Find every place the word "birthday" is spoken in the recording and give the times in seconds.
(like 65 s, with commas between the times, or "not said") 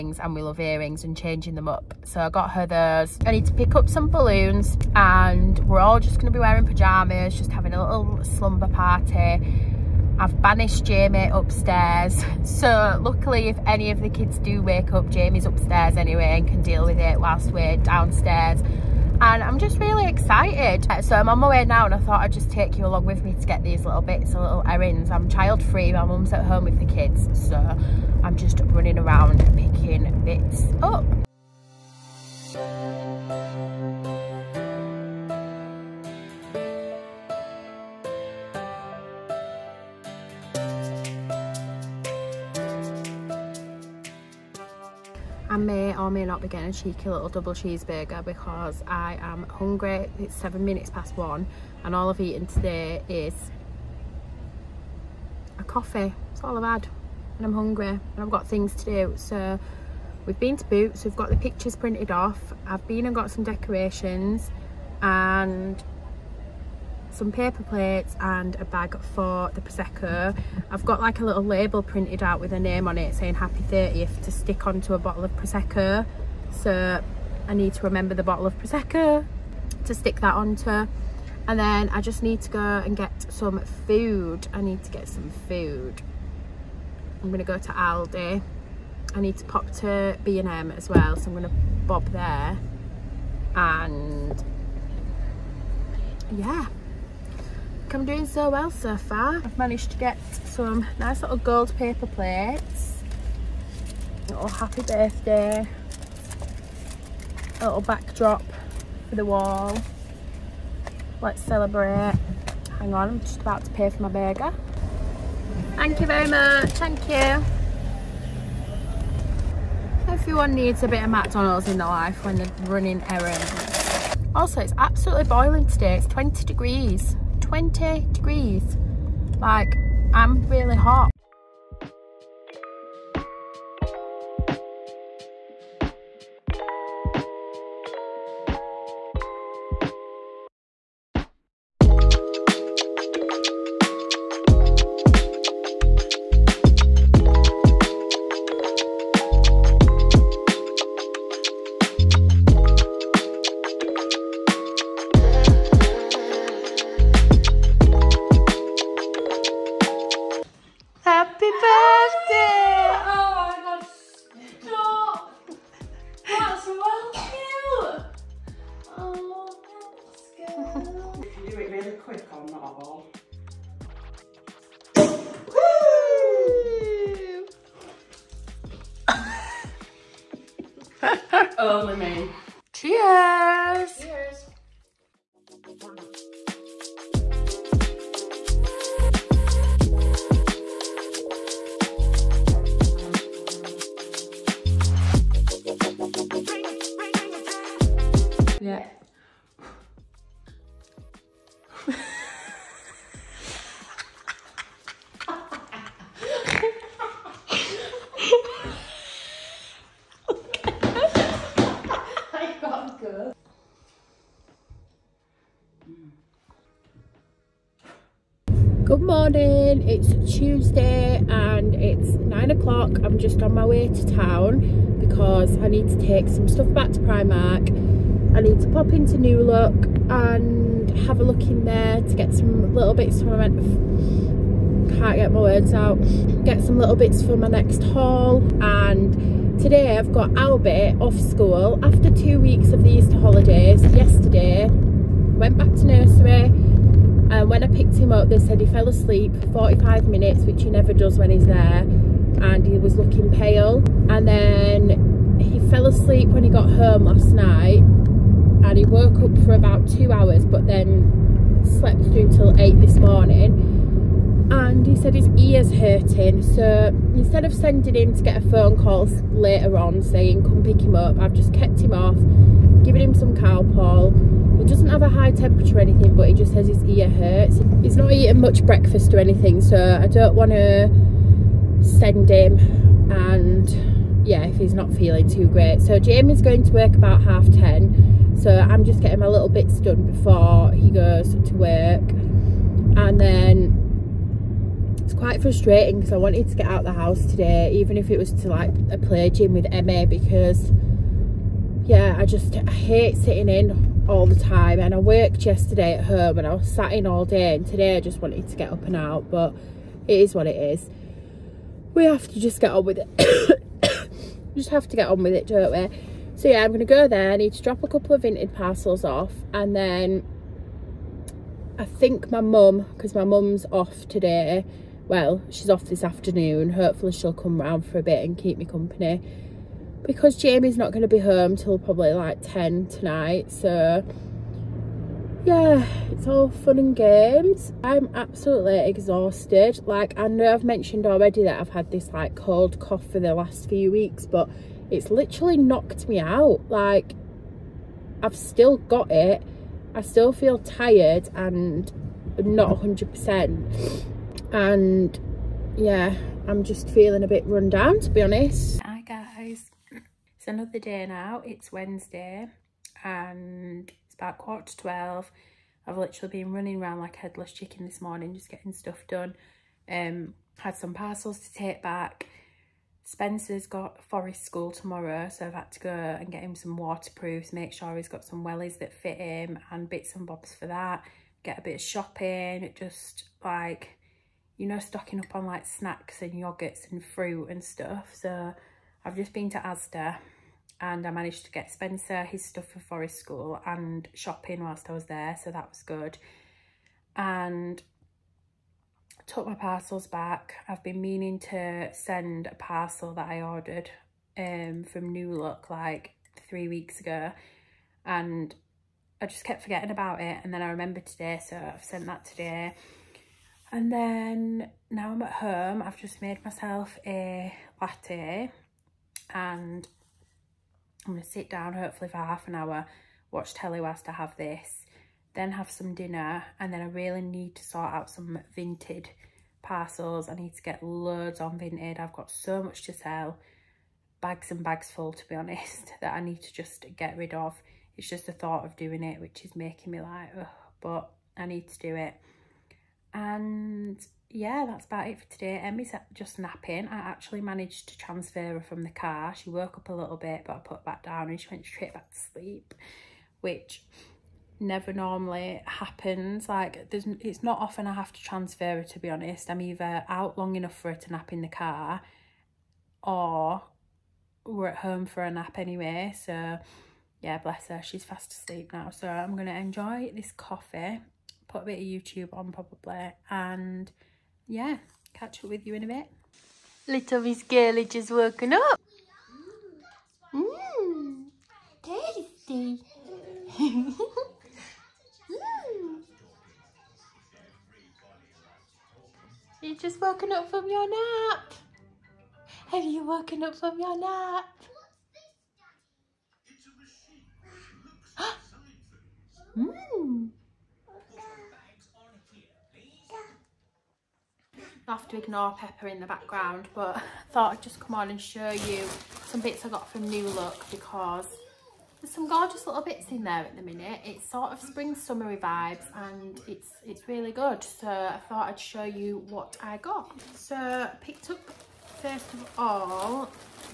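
104 s.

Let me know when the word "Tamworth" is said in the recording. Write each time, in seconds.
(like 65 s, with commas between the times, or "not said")
not said.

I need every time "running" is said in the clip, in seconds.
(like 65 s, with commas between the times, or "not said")
28 s, 122 s, 366 s.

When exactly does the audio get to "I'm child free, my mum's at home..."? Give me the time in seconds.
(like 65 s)
25 s.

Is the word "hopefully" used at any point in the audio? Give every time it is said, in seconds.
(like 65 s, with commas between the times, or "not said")
326 s, 421 s.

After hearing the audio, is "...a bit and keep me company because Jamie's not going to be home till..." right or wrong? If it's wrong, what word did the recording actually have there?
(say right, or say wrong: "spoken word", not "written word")
right.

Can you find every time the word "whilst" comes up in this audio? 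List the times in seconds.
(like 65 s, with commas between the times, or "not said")
17 s, 394 s, 423 s.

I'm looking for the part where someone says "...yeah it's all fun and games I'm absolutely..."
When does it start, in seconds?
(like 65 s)
335 s.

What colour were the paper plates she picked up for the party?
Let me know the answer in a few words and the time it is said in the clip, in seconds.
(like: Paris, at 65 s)
Gold, at 101 s.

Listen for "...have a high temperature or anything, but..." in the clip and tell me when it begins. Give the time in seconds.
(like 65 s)
274 s.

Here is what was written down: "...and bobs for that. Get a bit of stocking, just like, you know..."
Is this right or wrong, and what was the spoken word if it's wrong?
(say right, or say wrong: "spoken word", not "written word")
wrong: "shopping", not "stocking".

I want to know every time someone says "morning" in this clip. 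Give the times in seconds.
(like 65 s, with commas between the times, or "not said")
219 s, 262 s, 368 s.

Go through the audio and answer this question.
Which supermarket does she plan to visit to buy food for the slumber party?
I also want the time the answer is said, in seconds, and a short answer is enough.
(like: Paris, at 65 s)
Aldi, at 87 s.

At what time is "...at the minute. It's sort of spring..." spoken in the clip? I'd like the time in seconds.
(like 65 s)
513 s.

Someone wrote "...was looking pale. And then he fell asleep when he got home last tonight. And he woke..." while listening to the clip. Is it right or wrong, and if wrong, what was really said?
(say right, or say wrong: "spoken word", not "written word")
wrong: "night", not "tonight".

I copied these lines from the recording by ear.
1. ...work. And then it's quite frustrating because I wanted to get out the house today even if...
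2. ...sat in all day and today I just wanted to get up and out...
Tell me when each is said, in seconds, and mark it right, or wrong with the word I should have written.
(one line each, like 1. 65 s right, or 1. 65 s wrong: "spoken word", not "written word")
1. 291 s right
2. 306 s right.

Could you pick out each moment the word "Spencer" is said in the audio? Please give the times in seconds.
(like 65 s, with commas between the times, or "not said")
373 s, 391 s.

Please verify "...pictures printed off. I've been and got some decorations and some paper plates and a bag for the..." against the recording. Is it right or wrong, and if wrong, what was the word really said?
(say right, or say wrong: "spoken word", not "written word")
right.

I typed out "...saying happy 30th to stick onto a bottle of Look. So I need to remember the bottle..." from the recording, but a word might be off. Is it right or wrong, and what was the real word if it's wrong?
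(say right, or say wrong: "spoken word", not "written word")
wrong: "Prosecco", not "Look".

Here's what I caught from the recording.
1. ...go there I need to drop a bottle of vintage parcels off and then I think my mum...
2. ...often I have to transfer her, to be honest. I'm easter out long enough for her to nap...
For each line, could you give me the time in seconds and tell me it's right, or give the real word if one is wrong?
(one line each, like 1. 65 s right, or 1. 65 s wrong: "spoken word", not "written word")
1. 316 s wrong: "couple", not "bottle"
2. 457 s wrong: "either", not "easter".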